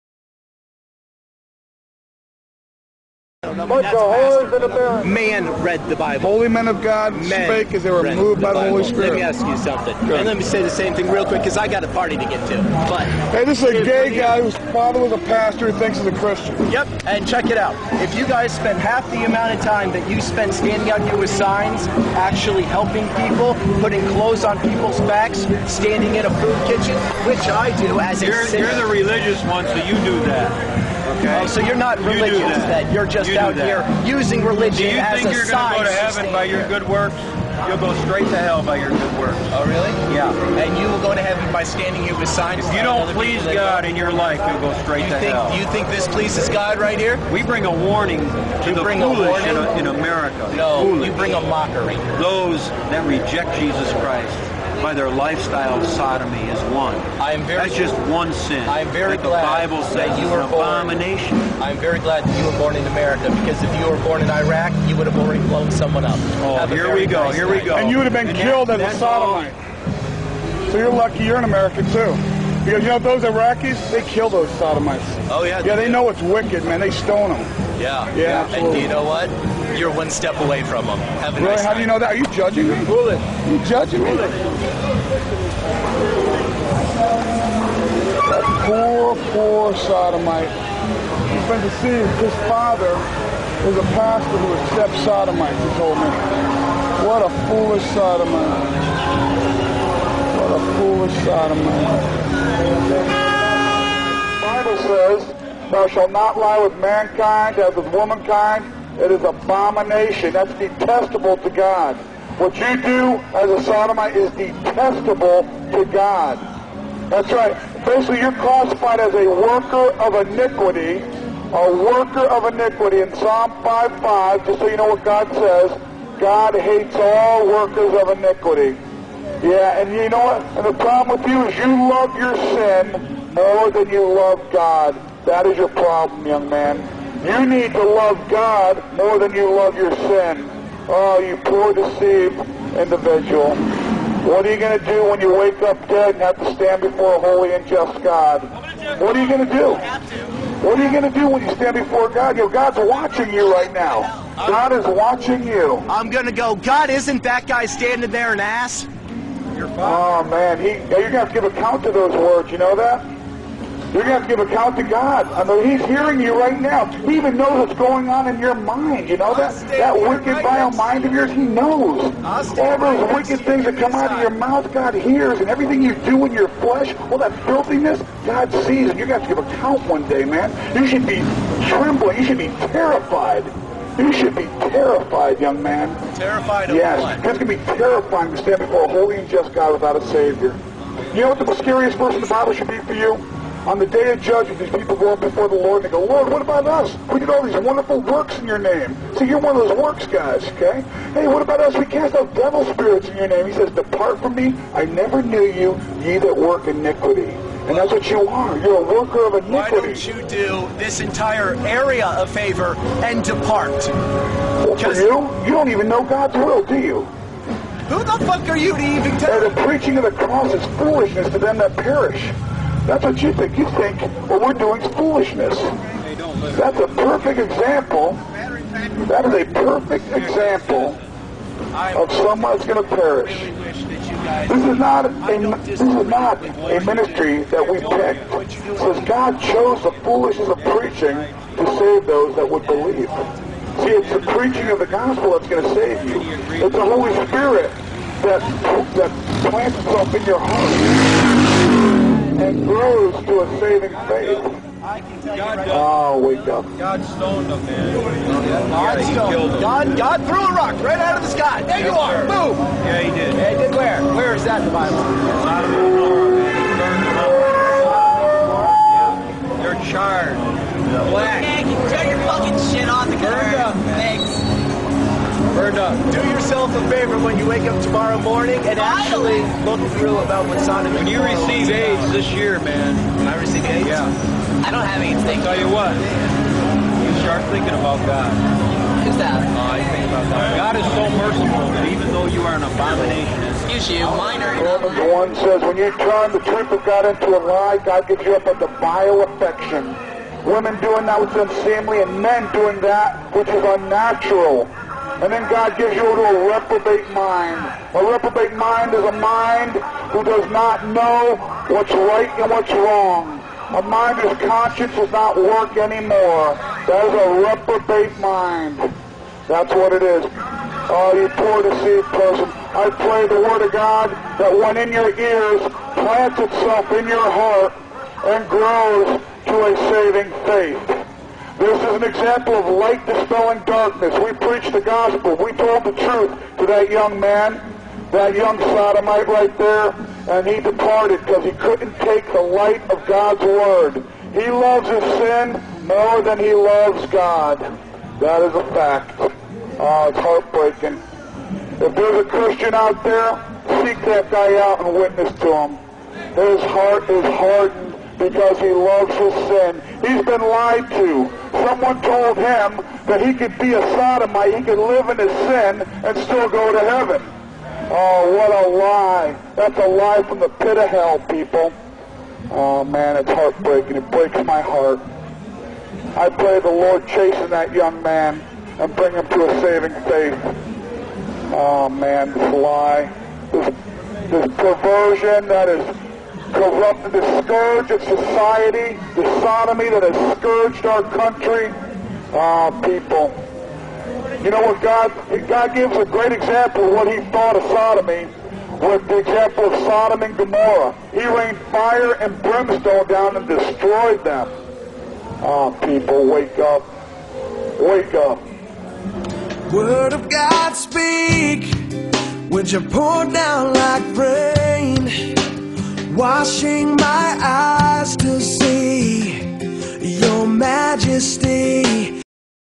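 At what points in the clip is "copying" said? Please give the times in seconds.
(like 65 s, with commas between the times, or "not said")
not said.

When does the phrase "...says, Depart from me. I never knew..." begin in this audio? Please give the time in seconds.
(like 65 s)
203 s.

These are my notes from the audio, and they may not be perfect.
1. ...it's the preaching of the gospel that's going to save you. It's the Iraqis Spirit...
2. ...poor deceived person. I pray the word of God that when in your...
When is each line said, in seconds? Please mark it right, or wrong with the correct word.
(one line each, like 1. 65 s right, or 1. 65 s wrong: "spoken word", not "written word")
1. 243 s wrong: "Holy", not "Iraqis"
2. 321 s right.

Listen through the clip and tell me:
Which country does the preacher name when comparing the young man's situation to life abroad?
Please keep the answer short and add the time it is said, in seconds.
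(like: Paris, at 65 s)
Iraq, at 64 s.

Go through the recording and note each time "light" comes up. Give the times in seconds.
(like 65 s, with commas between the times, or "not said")
332 s, 342 s.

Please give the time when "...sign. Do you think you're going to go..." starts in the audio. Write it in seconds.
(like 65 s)
35 s.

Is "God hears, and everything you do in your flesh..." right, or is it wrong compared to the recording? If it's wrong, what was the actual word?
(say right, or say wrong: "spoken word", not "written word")
right.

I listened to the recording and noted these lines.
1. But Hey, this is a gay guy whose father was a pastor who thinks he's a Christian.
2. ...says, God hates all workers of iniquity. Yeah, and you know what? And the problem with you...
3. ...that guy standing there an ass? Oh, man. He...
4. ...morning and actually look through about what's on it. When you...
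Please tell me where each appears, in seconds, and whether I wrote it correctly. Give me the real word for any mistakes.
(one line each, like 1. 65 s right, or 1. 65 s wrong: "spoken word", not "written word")
1. 12 s right
2. 125 s right
3. 157 s right
4. 278 s right.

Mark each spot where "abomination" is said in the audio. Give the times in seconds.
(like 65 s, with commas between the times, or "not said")
60 s, 109 s, 292 s.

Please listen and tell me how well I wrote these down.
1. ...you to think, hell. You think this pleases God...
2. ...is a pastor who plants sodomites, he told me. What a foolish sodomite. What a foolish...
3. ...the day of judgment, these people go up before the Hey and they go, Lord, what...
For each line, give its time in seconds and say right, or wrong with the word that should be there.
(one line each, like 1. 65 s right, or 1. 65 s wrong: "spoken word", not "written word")
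1. 45 s right
2. 93 s wrong: "accepts", not "plants"
3. 193 s wrong: "Lord", not "Hey".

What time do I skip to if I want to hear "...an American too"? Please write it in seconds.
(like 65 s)
71 s.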